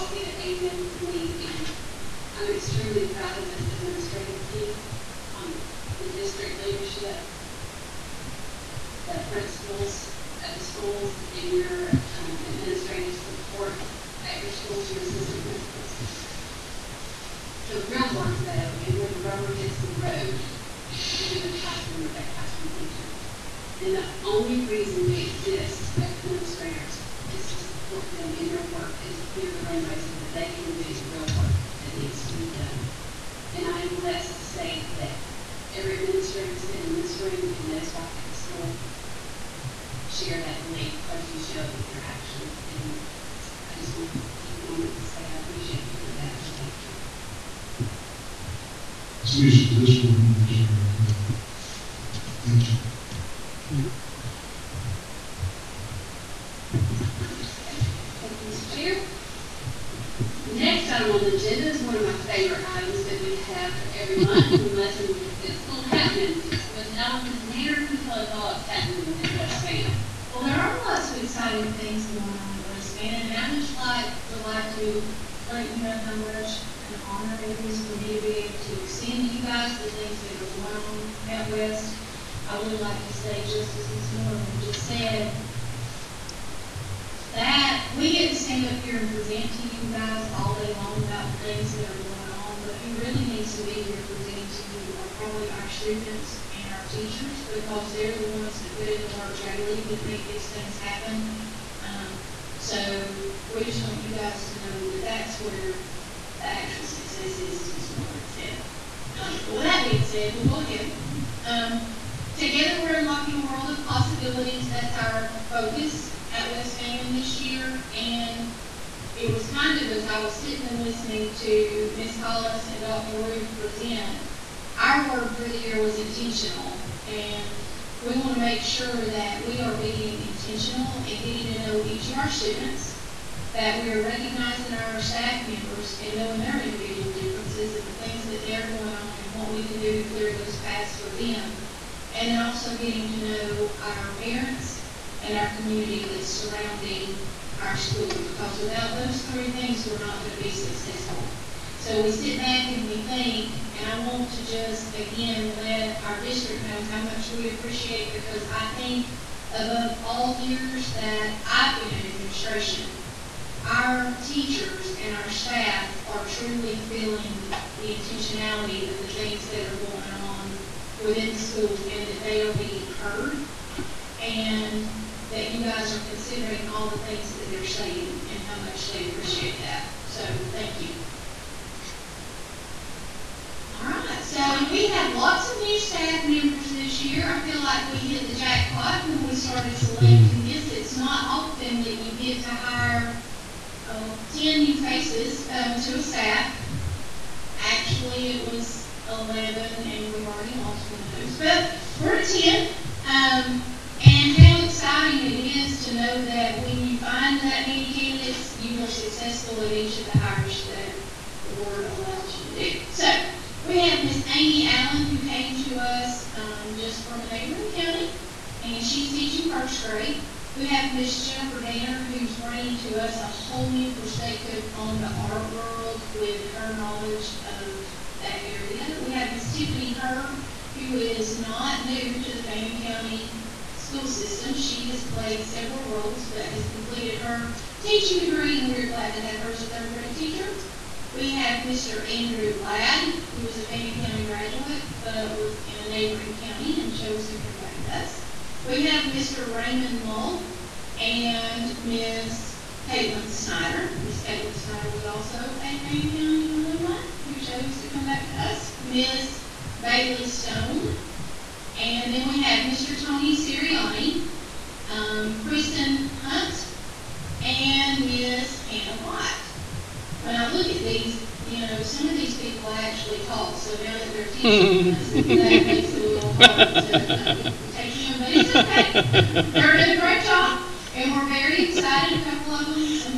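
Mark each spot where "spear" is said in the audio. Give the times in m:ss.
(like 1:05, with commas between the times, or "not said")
not said.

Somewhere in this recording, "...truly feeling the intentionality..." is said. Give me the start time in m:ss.
2:46.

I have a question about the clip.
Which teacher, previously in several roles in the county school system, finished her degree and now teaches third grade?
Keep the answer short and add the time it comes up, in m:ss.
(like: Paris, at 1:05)
Tiffany Herb, at 3:49.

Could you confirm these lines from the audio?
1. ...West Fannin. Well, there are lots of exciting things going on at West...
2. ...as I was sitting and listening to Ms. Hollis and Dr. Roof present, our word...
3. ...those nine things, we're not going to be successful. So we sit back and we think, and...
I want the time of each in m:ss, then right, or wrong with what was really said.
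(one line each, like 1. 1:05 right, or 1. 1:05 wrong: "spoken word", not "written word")
1. 1:09 right
2. 1:59 right
3. 2:28 wrong: "three", not "nine".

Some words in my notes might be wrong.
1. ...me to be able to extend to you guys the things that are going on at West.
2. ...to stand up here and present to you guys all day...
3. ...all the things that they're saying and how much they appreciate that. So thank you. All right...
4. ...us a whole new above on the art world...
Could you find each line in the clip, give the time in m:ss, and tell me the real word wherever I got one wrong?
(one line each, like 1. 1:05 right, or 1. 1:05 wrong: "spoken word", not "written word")
1. 1:17 right
2. 1:28 right
3. 2:56 right
4. 3:43 wrong: "perspective", not "above".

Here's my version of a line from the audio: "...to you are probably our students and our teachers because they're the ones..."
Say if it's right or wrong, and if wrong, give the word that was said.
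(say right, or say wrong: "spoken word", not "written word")
right.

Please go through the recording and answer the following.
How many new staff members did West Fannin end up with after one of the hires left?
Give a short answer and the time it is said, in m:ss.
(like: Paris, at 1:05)
10, at 3:21.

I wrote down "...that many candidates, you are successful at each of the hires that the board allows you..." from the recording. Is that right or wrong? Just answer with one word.
right.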